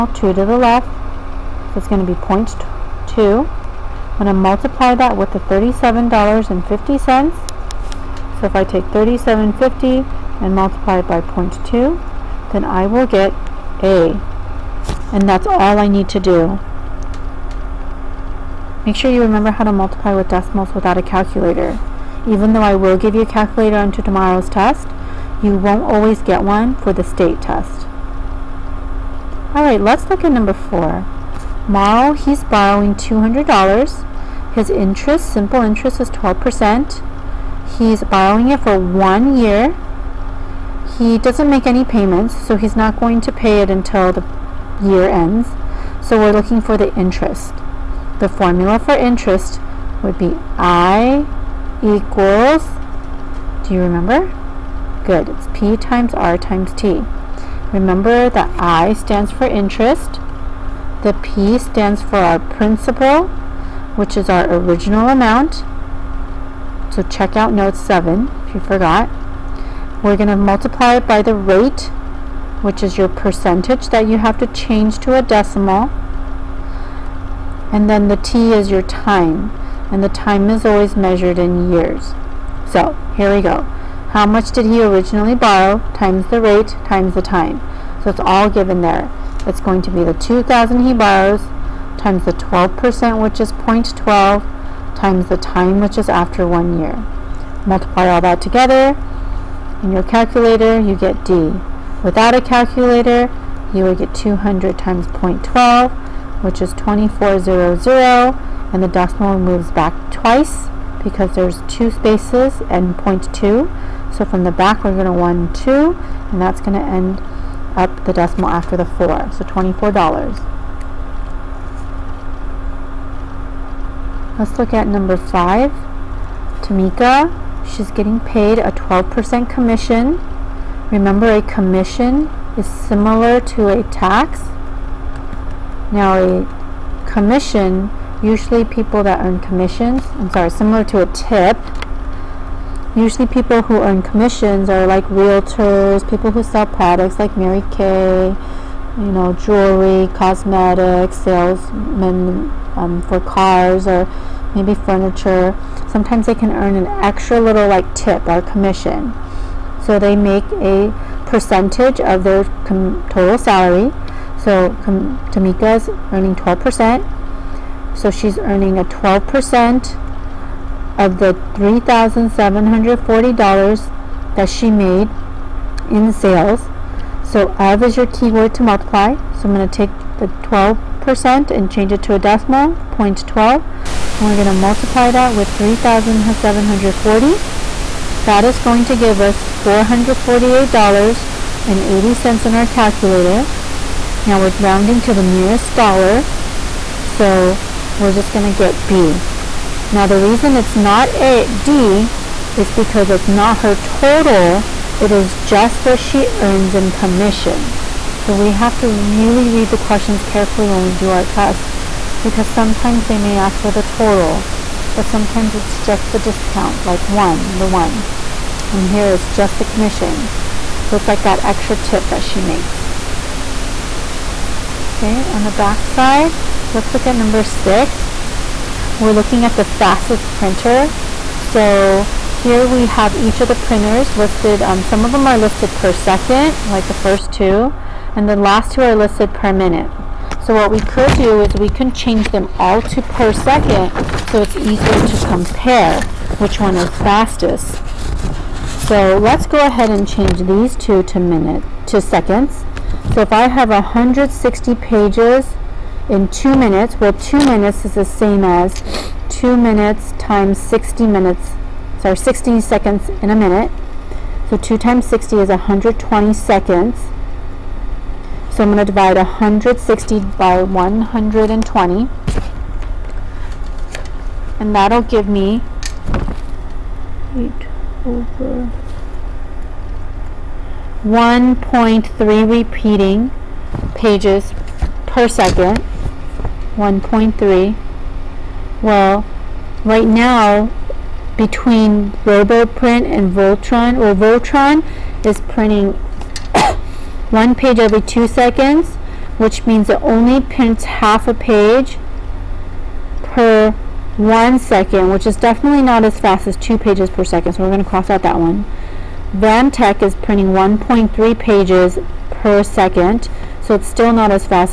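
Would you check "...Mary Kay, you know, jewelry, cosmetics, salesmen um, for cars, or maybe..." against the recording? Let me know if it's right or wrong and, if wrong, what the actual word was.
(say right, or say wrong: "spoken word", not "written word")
right.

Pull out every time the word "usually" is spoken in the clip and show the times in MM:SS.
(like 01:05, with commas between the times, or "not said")
02:18, 02:22.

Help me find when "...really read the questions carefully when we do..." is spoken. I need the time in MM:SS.
03:28.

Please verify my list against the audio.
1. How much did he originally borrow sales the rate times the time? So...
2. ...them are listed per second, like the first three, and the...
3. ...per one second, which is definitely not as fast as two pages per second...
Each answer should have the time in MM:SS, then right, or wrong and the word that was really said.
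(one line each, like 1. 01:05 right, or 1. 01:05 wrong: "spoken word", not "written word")
1. 01:24 wrong: "times", not "sales"
2. 03:55 wrong: "two", not "three"
3. 05:03 right.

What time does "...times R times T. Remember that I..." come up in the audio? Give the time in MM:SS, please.
00:55.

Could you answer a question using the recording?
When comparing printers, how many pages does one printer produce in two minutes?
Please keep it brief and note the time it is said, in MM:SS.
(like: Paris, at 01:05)
160, at 04:13.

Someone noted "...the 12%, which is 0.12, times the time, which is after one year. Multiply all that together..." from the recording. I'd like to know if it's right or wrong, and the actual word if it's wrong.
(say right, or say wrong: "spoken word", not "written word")
right.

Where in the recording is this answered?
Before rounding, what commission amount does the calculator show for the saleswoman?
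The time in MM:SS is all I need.
03:09.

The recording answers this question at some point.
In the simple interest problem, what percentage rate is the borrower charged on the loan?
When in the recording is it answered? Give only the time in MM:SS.
00:34.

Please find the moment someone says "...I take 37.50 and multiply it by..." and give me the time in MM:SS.
00:08.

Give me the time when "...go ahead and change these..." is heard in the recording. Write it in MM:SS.
04:09.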